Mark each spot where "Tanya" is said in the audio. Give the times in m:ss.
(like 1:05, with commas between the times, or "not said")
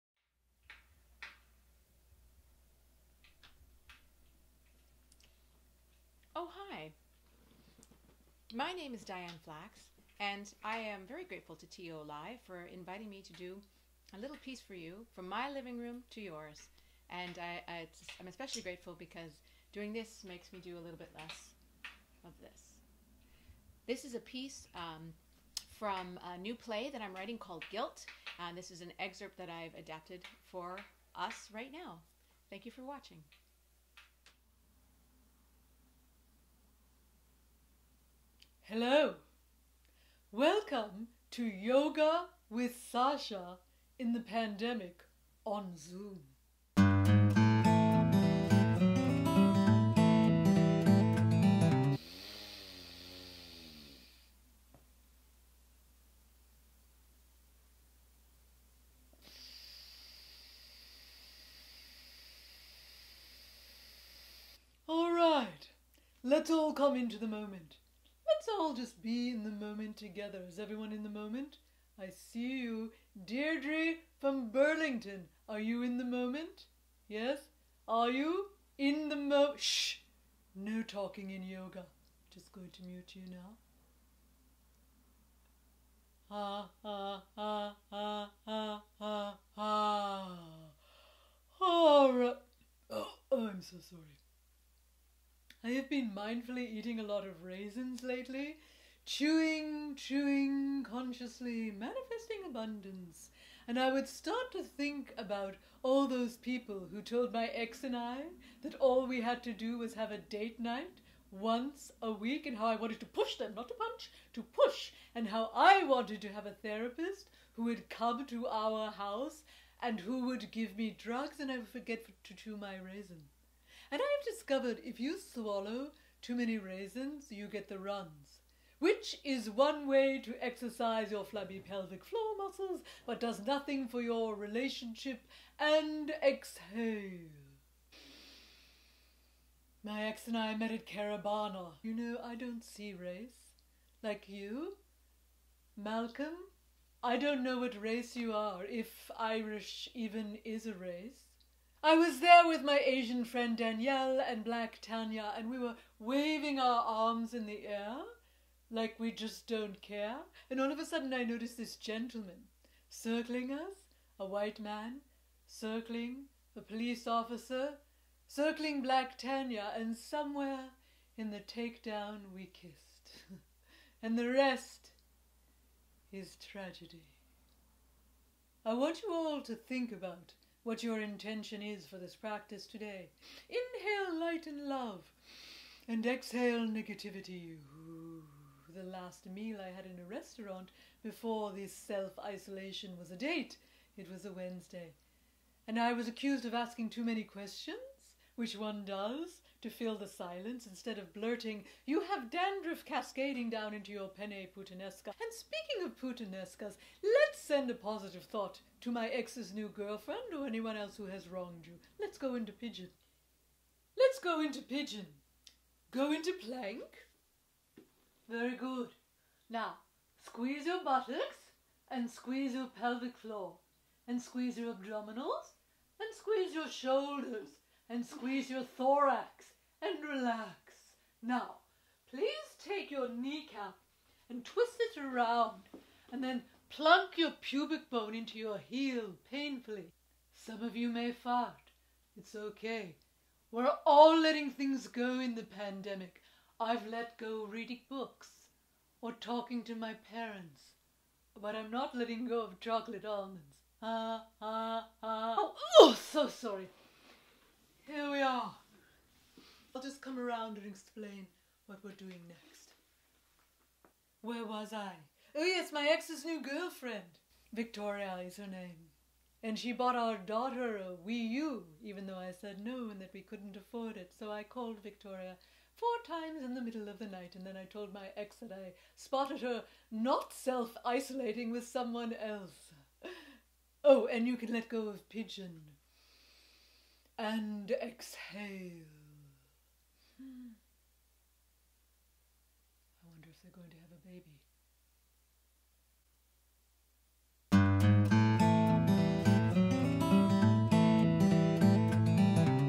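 2:34, 2:49.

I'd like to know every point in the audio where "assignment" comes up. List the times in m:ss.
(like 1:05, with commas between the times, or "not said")
not said.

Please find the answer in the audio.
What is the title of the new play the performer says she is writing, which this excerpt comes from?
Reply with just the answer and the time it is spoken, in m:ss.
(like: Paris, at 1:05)
Guilt, at 0:27.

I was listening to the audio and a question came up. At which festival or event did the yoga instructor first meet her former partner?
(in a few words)
Caribana.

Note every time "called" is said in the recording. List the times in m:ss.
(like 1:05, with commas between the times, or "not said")
0:27, 4:34.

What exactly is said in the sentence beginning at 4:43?
Oh, and you can let go of Pigeon and exhale.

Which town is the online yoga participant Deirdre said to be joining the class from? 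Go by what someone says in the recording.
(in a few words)
Burlington.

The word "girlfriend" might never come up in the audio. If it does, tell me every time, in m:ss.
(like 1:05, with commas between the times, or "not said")
3:29, 4:26.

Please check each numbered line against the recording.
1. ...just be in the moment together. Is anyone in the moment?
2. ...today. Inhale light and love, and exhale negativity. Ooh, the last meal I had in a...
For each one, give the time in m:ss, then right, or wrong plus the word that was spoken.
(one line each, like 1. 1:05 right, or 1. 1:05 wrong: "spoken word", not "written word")
1. 1:08 wrong: "everyone", not "anyone"
2. 3:02 right.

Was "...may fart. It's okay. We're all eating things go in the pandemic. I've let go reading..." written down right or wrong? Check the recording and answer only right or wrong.
wrong.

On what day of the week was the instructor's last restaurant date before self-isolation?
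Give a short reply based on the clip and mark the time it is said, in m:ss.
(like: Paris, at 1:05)
Wednesday, at 3:14.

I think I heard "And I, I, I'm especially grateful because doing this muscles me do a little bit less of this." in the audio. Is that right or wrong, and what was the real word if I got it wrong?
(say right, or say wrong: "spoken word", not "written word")
wrong: "makes", not "muscles".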